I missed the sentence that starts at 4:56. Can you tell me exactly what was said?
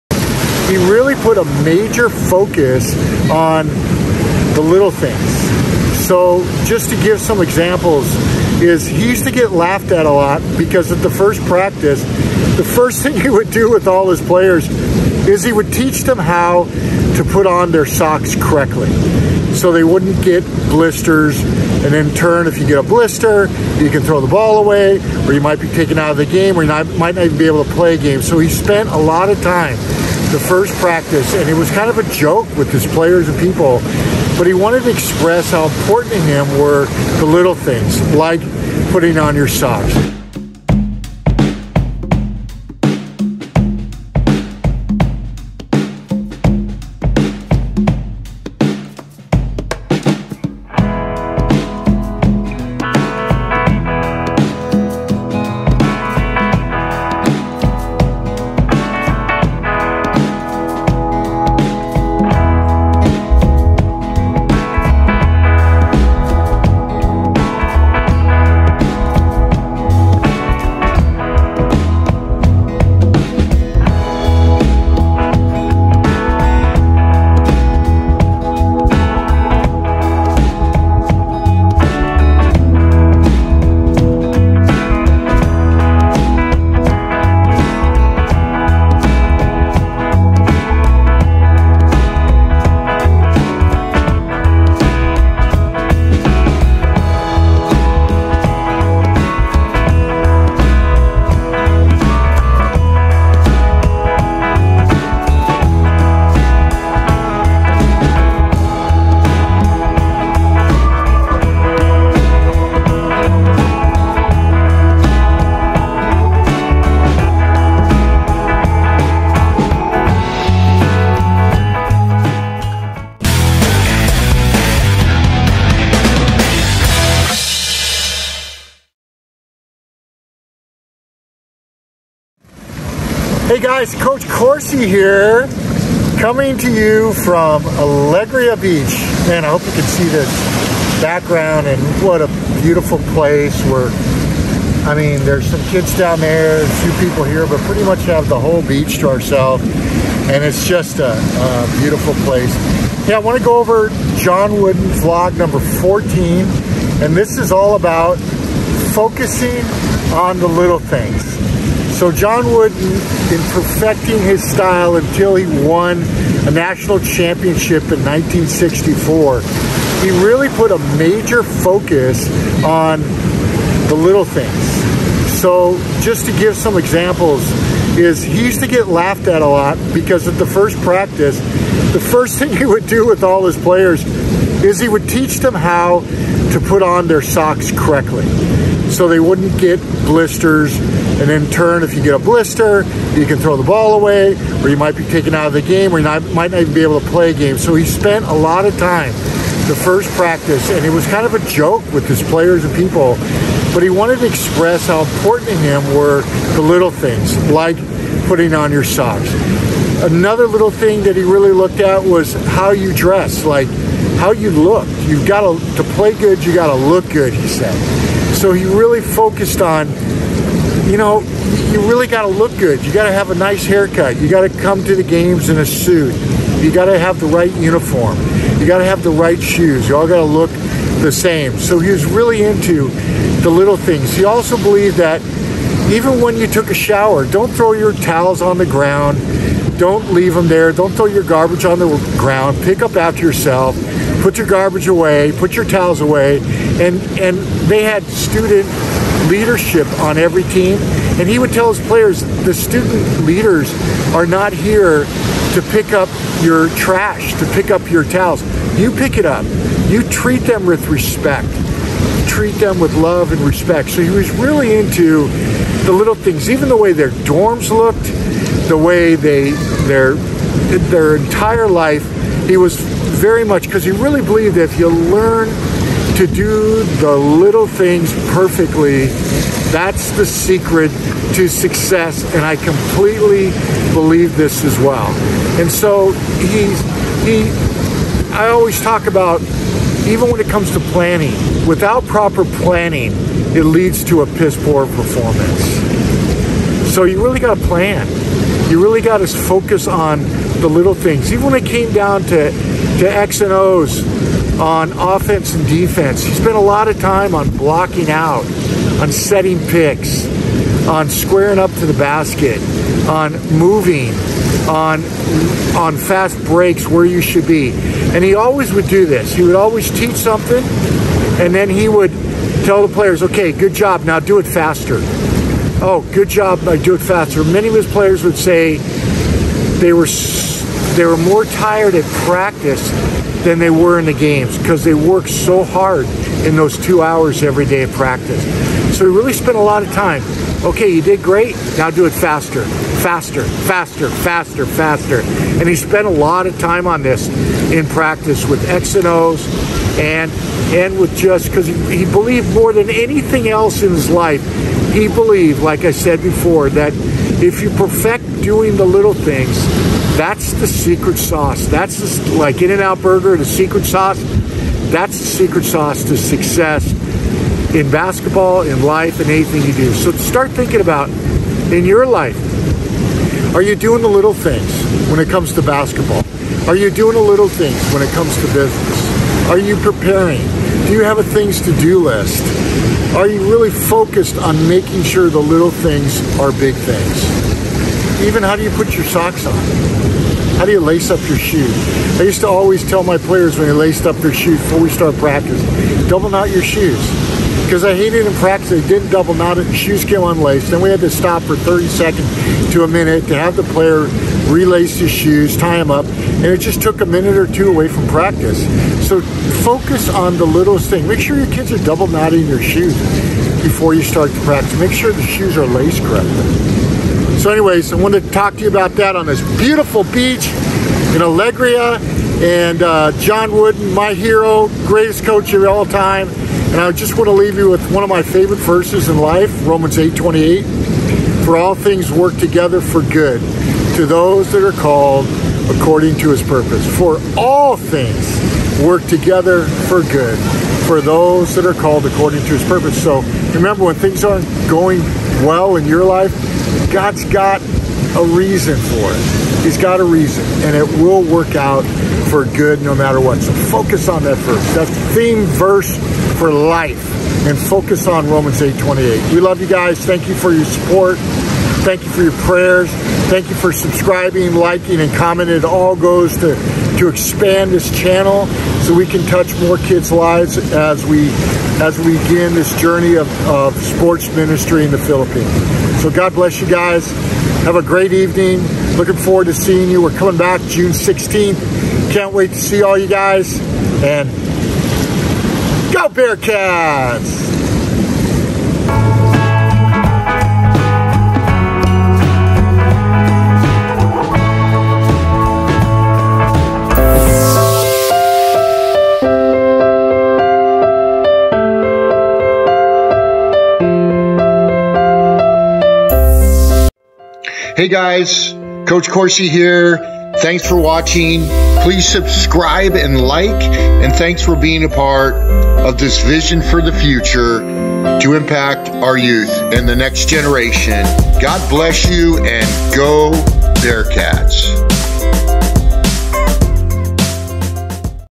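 So you really got to plan.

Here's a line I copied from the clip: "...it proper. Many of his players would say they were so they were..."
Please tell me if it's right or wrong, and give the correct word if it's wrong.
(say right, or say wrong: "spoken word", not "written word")
wrong: "faster", not "proper".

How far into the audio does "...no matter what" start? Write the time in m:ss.
7:32.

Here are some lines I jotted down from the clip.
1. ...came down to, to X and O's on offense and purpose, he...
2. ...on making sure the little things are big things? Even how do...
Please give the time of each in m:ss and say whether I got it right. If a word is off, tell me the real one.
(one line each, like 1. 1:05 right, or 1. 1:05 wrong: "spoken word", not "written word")
1. 5:01 wrong: "defense", not "purpose"
2. 6:24 right.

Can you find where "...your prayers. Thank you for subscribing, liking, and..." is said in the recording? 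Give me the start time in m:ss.
7:42.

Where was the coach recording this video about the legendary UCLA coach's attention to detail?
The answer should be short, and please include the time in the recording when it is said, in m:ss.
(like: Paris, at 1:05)
Alegria Beach, at 2:17.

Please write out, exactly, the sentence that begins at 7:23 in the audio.
So Remember, when things aren't going well in your life, God's got a reason for it.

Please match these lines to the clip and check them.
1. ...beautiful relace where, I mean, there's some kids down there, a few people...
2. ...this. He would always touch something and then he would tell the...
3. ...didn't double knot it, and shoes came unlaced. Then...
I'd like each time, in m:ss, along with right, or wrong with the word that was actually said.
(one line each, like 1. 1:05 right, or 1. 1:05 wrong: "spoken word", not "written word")
1. 2:22 wrong: "place", not "relace"
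2. 5:19 wrong: "teach", not "touch"
3. 6:38 right.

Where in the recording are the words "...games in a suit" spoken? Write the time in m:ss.
3:45.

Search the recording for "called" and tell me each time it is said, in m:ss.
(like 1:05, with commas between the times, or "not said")
7:14, 7:21.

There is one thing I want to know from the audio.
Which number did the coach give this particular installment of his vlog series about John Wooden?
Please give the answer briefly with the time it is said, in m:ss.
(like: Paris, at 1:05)
14, at 2:35.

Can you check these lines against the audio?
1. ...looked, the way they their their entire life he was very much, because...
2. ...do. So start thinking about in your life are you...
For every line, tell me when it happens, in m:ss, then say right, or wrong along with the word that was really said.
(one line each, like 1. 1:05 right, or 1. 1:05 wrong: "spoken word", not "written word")
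1. 4:27 right
2. 6:09 right.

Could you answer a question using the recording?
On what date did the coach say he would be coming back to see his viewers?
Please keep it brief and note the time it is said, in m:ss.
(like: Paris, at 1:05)
June 16, at 8:00.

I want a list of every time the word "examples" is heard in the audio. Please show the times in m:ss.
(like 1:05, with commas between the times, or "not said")
0:07, 2:56.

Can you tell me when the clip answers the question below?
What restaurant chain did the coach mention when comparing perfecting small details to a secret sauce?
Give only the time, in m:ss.
6:02.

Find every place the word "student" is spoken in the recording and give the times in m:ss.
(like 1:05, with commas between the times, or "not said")
4:08, 4:12.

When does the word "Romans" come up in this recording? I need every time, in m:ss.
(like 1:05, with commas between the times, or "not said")
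7:09, 7:38.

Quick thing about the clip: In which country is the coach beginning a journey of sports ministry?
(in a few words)
Philippines.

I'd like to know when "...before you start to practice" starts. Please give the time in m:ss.
6:53.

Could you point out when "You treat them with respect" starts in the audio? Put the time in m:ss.
4:19.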